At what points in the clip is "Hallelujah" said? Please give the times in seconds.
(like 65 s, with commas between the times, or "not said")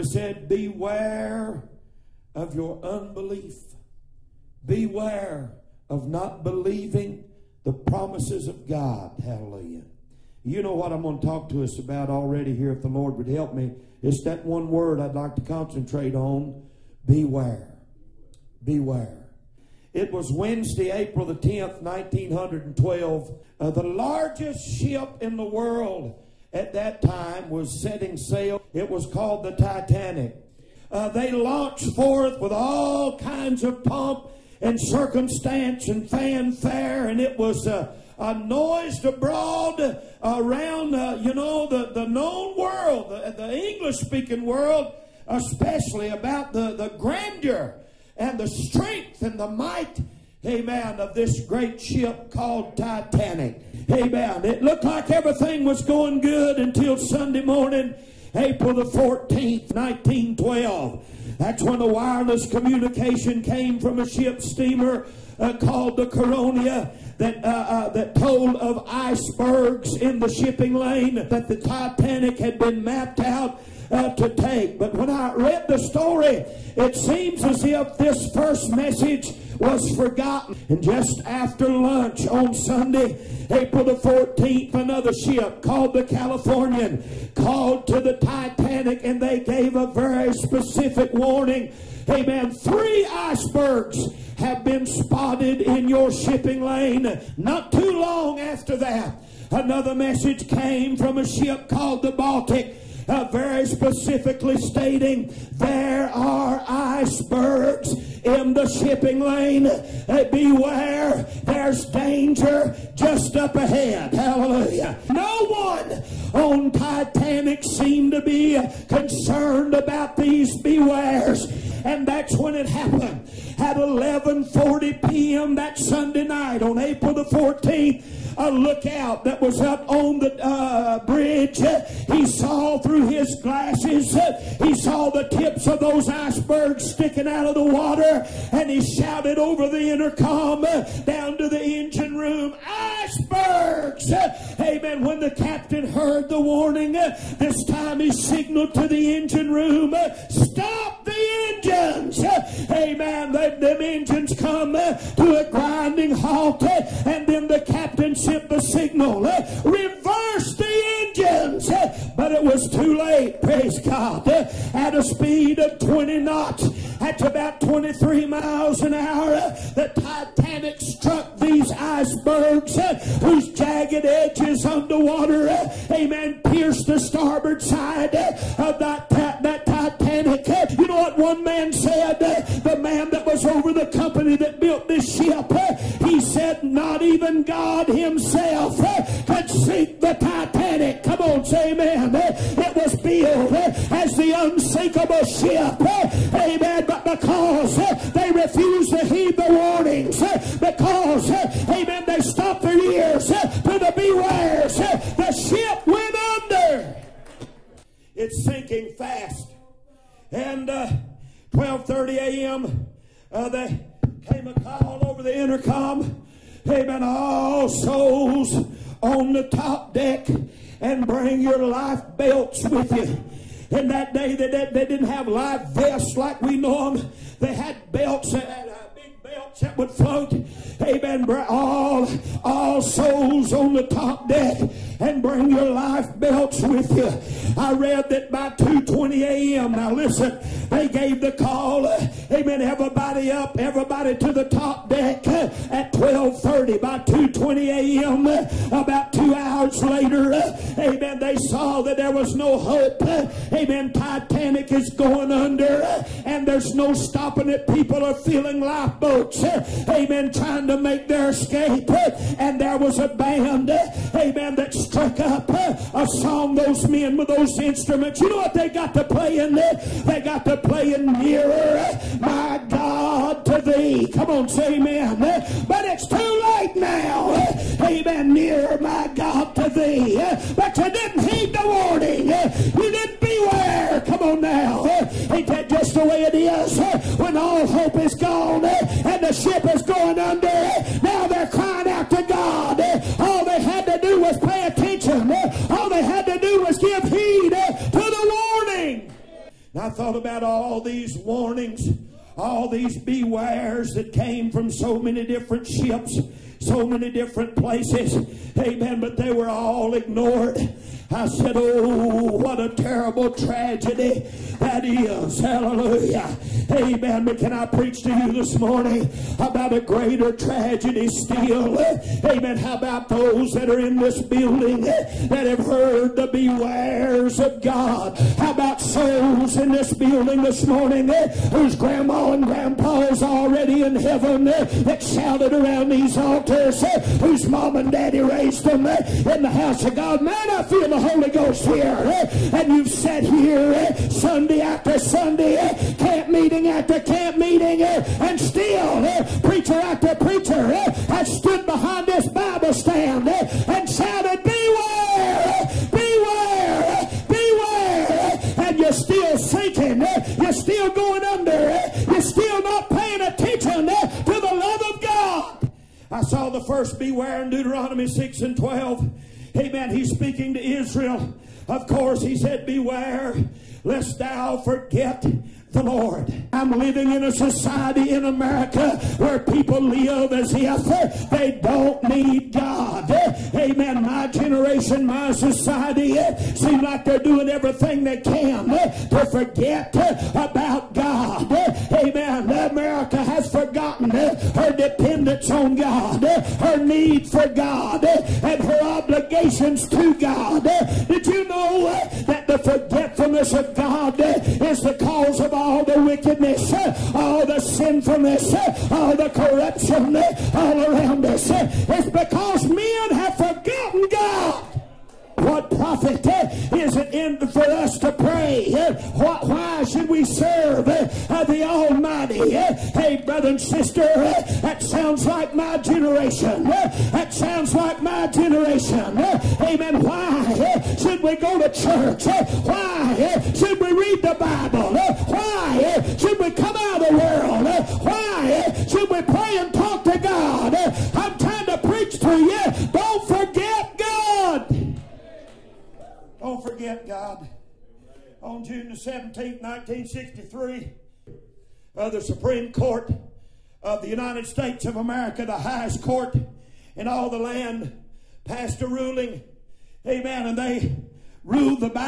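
9 s, 114 s, 315 s.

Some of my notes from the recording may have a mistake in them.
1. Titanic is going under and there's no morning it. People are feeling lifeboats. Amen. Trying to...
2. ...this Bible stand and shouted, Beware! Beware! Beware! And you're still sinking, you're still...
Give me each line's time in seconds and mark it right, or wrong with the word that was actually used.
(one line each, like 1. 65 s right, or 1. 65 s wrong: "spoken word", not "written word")
1. 253 s wrong: "stopping", not "morning"
2. 352 s right.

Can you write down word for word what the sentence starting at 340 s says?
Man, I feel the Holy Ghost here, eh?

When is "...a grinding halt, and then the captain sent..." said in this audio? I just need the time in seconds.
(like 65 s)
155 s.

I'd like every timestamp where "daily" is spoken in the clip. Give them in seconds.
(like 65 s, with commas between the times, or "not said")
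not said.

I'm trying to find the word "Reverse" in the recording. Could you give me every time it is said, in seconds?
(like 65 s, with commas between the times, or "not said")
159 s.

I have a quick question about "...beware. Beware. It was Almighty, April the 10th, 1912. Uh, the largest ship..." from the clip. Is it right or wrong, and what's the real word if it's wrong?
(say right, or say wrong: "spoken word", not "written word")
wrong: "Wednesday", not "Almighty".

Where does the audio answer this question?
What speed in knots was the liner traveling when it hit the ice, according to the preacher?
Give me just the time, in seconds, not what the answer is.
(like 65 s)
165 s.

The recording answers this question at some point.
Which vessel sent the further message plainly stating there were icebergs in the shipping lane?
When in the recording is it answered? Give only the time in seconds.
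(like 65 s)
102 s.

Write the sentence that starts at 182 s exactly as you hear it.
The man that was over the company that built this ship.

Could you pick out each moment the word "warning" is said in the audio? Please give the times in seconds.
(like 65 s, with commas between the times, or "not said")
91 s, 146 s, 199 s, 281 s, 301 s.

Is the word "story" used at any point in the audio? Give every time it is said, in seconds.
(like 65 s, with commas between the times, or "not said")
75 s.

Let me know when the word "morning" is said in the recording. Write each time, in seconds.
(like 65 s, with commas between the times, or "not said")
57 s, 318 s, 330 s.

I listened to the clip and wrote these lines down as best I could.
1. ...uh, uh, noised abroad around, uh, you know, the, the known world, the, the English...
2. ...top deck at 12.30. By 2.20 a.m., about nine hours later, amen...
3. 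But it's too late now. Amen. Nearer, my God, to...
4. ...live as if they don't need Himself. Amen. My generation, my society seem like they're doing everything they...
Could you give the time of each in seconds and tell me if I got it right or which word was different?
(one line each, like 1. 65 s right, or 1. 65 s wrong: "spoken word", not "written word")
1. 37 s right
2. 244 s wrong: "two", not "nine"
3. 275 s right
4. 379 s wrong: "God", not "Himself".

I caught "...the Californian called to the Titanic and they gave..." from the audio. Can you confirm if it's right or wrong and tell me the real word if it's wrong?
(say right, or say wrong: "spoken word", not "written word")
right.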